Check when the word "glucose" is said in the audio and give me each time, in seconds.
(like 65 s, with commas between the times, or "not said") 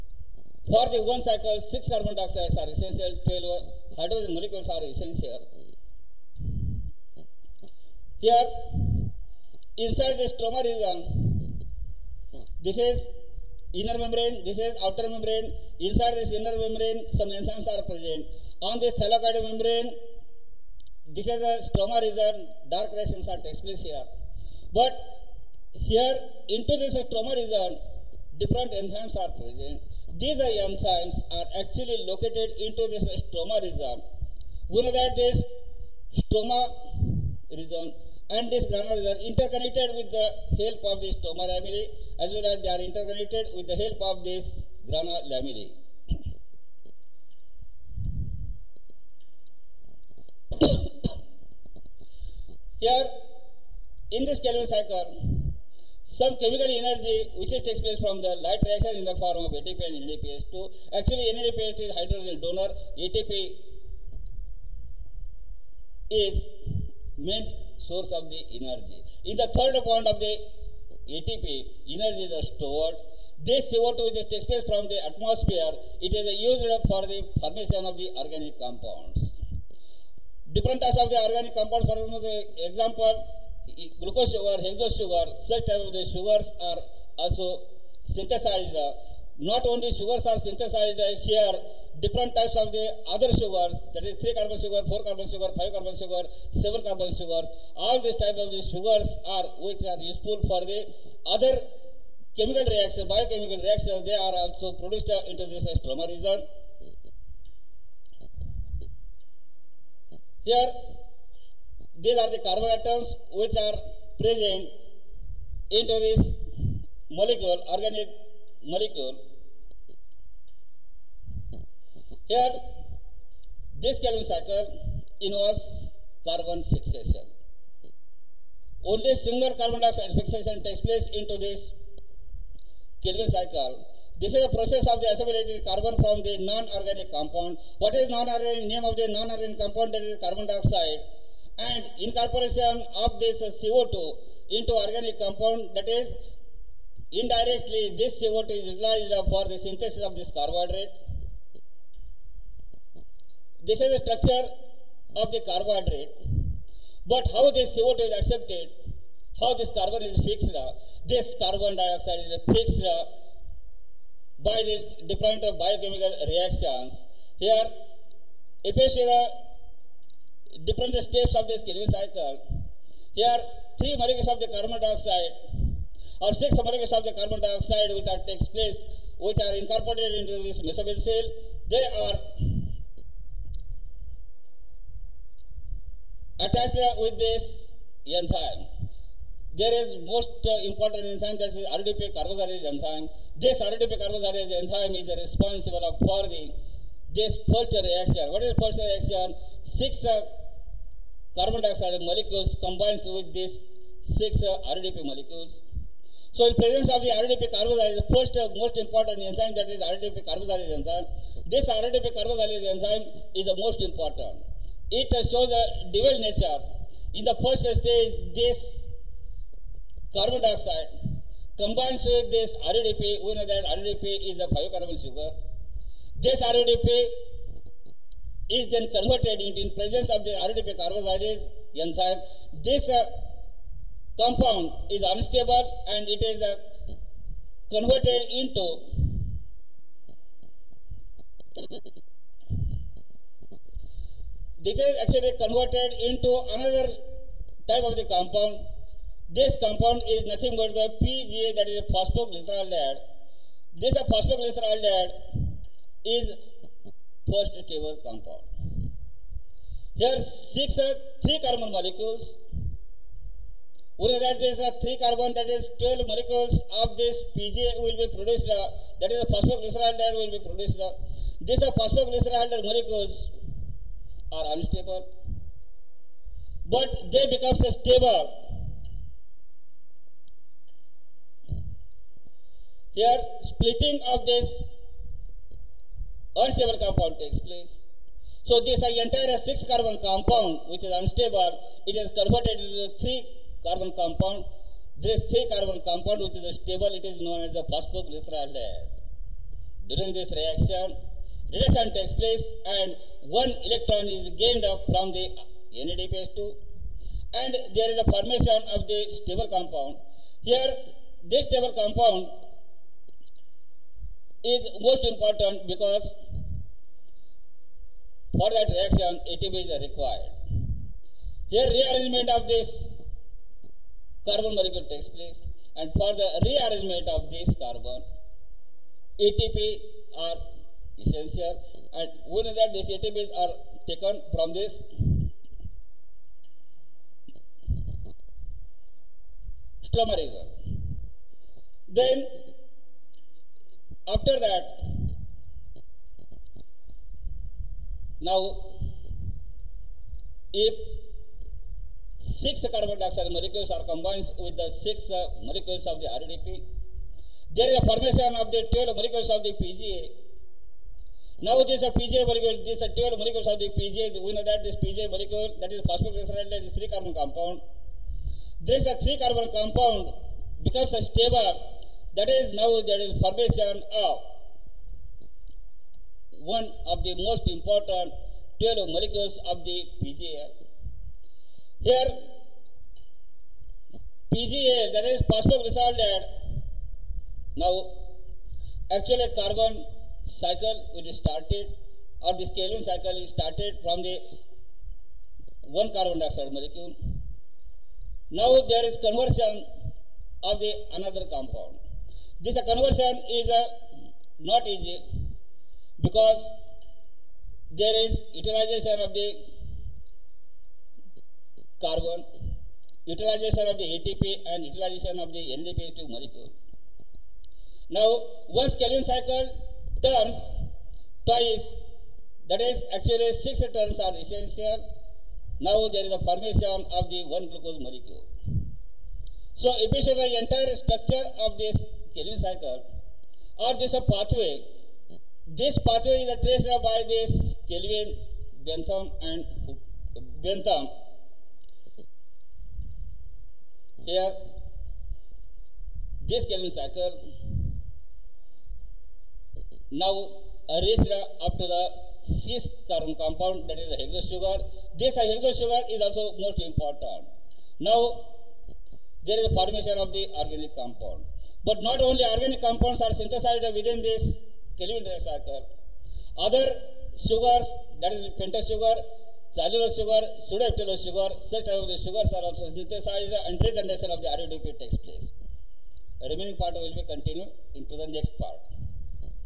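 84 s, 427 s.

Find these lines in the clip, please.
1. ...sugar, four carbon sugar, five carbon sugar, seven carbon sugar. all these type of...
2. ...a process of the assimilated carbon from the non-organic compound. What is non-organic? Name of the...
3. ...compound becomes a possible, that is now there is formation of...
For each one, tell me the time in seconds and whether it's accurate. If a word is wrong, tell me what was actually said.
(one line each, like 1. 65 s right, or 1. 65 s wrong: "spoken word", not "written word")
1. 94 s right
2. 134 s right
3. 369 s wrong: "stable", not "possible".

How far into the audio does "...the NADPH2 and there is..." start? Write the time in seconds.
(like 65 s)
305 s.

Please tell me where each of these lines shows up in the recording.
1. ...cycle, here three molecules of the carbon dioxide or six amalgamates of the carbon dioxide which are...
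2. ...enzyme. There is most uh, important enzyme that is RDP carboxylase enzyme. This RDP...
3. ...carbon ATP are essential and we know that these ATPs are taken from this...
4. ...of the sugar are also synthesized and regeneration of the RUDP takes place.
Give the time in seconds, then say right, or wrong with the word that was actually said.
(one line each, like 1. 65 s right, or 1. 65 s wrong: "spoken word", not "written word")
1. 171 s right
2. 188 s right
3. 327 s right
4. 471 s right.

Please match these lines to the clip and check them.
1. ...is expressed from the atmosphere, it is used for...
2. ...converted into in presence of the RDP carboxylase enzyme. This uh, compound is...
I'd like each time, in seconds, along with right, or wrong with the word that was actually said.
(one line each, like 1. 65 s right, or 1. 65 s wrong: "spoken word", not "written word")
1. 74 s right
2. 228 s right.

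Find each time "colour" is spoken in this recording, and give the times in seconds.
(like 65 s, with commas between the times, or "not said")
not said.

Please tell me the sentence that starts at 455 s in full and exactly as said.
This hexose sugar is also most important.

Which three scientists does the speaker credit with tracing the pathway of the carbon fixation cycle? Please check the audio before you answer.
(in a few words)
Calvin, Benson and Bassham.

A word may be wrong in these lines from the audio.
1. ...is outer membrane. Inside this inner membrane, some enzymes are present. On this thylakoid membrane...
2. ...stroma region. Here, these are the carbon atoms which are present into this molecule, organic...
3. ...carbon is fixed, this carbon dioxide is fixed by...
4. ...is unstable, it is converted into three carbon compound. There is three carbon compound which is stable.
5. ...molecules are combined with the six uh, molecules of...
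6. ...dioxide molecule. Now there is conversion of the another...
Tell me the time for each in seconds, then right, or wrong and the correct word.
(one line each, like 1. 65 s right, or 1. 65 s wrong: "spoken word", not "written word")
1. 14 s right
2. 105 s right
3. 159 s right
4. 290 s right
5. 353 s right
6. 396 s right.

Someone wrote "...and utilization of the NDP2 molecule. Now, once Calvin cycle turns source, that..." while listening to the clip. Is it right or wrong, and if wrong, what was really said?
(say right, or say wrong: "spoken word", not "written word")
wrong: "twice", not "source".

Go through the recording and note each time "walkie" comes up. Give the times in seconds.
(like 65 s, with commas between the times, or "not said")
not said.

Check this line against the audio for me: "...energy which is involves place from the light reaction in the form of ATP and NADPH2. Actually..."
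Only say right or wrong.
wrong.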